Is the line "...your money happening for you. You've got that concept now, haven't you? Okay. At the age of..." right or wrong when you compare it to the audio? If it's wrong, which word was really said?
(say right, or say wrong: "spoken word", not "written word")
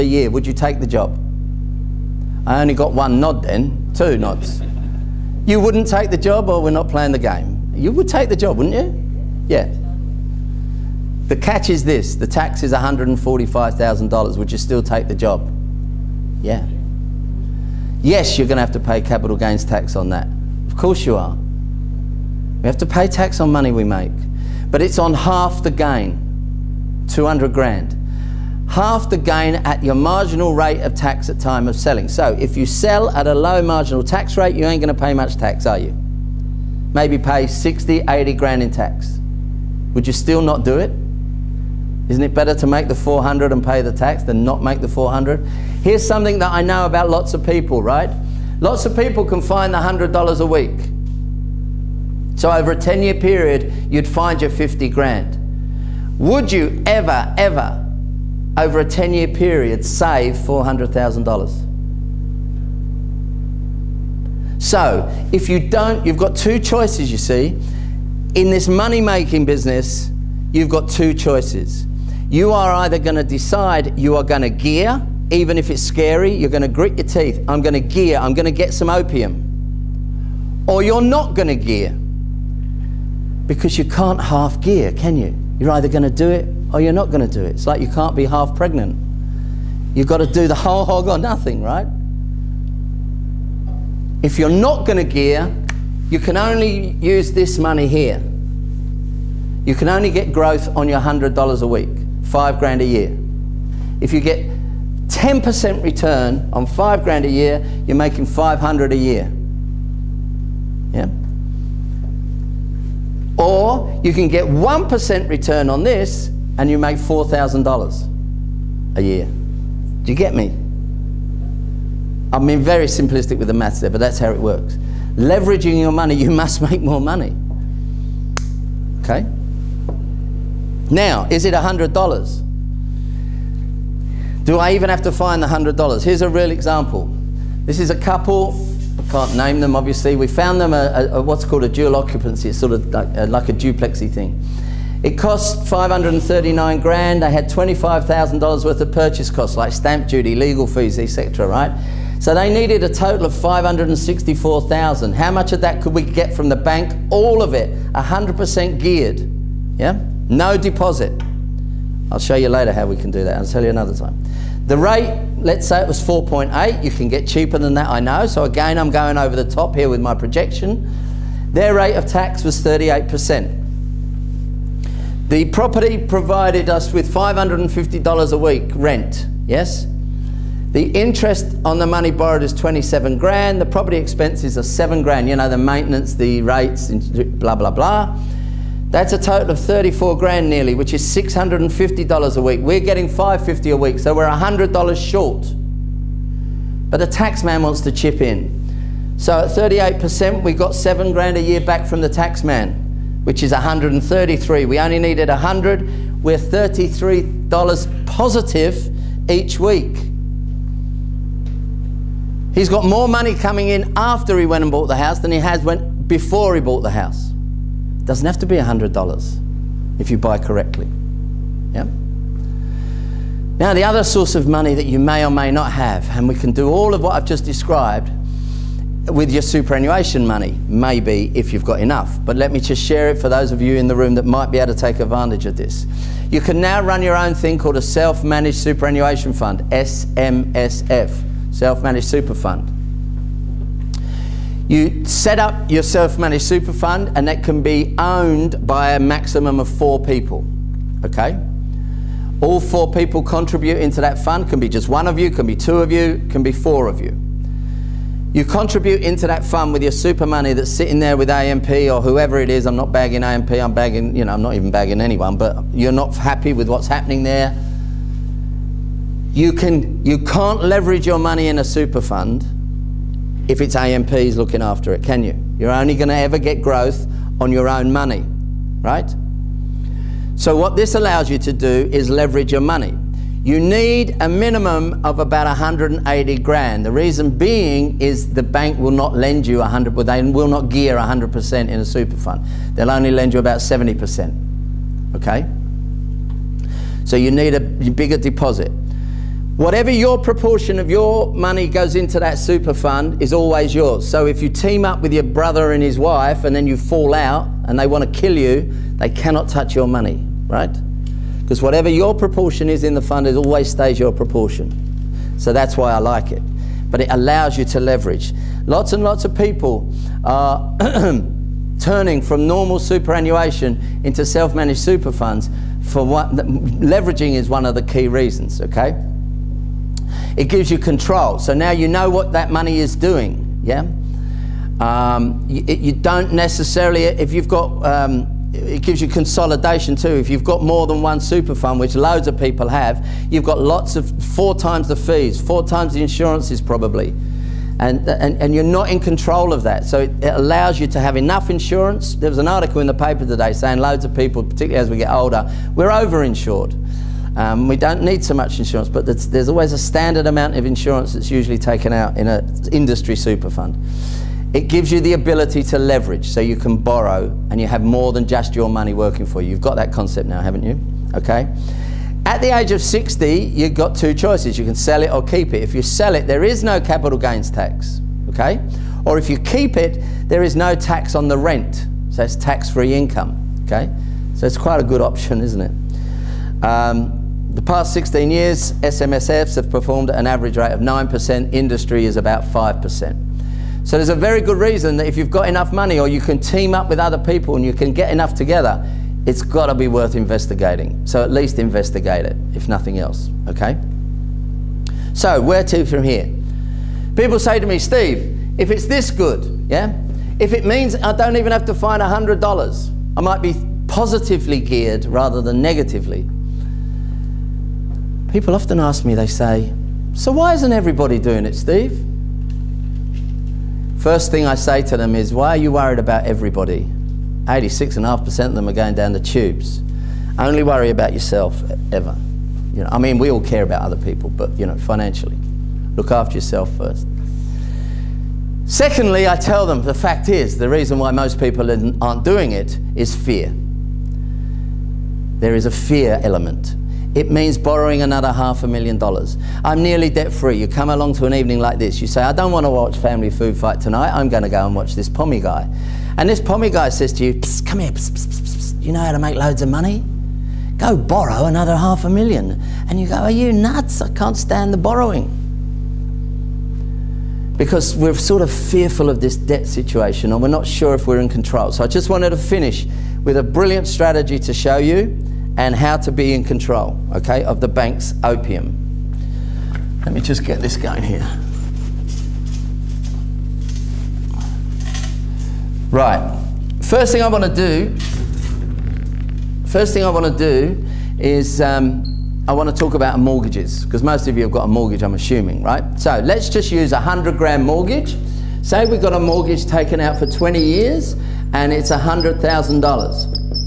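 wrong: "working", not "happening".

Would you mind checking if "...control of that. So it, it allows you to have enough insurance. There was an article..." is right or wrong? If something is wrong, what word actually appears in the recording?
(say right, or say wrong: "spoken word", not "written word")
right.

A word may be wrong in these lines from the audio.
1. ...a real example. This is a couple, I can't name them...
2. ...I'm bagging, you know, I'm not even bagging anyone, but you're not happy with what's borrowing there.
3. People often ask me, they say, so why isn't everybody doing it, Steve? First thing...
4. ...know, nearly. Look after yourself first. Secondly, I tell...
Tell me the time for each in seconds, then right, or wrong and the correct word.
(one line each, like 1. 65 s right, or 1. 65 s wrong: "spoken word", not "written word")
1. 136 s right
2. 263 s wrong: "happening", not "borrowing"
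3. 418 s right
4. 434 s wrong: "financially", not "nearly".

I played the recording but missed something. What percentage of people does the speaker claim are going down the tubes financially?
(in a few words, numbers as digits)
86.5%.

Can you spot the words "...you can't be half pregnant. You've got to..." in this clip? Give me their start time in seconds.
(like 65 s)
87 s.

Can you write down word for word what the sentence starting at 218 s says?
Doesn't have to be $100 if you buy correctly.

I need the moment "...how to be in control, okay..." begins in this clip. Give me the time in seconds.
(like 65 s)
475 s.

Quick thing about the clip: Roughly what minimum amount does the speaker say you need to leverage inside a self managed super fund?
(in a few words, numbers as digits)
$180,000.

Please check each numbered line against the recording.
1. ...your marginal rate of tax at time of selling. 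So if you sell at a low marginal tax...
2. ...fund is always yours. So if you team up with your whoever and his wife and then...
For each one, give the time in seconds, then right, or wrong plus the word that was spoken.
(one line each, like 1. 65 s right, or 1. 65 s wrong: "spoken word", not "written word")
1. 29 s right
2. 302 s wrong: "brother", not "whoever".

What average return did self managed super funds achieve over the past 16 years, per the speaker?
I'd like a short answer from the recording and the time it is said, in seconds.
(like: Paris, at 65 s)
9%, at 390 s.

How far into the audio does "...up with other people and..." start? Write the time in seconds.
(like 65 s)
396 s.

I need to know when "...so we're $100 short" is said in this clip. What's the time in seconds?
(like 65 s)
193 s.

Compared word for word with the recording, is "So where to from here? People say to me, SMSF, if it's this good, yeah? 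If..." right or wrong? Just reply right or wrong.
wrong.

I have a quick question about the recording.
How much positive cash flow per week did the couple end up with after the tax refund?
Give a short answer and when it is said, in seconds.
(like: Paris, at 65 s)
$33, at 206 s.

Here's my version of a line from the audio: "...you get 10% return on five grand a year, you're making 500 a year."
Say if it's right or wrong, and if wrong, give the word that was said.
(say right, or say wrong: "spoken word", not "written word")
right.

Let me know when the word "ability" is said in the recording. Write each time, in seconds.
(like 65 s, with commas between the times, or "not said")
365 s.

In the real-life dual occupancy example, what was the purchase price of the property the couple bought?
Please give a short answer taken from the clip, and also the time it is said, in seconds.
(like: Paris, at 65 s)
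$539,000, at 145 s.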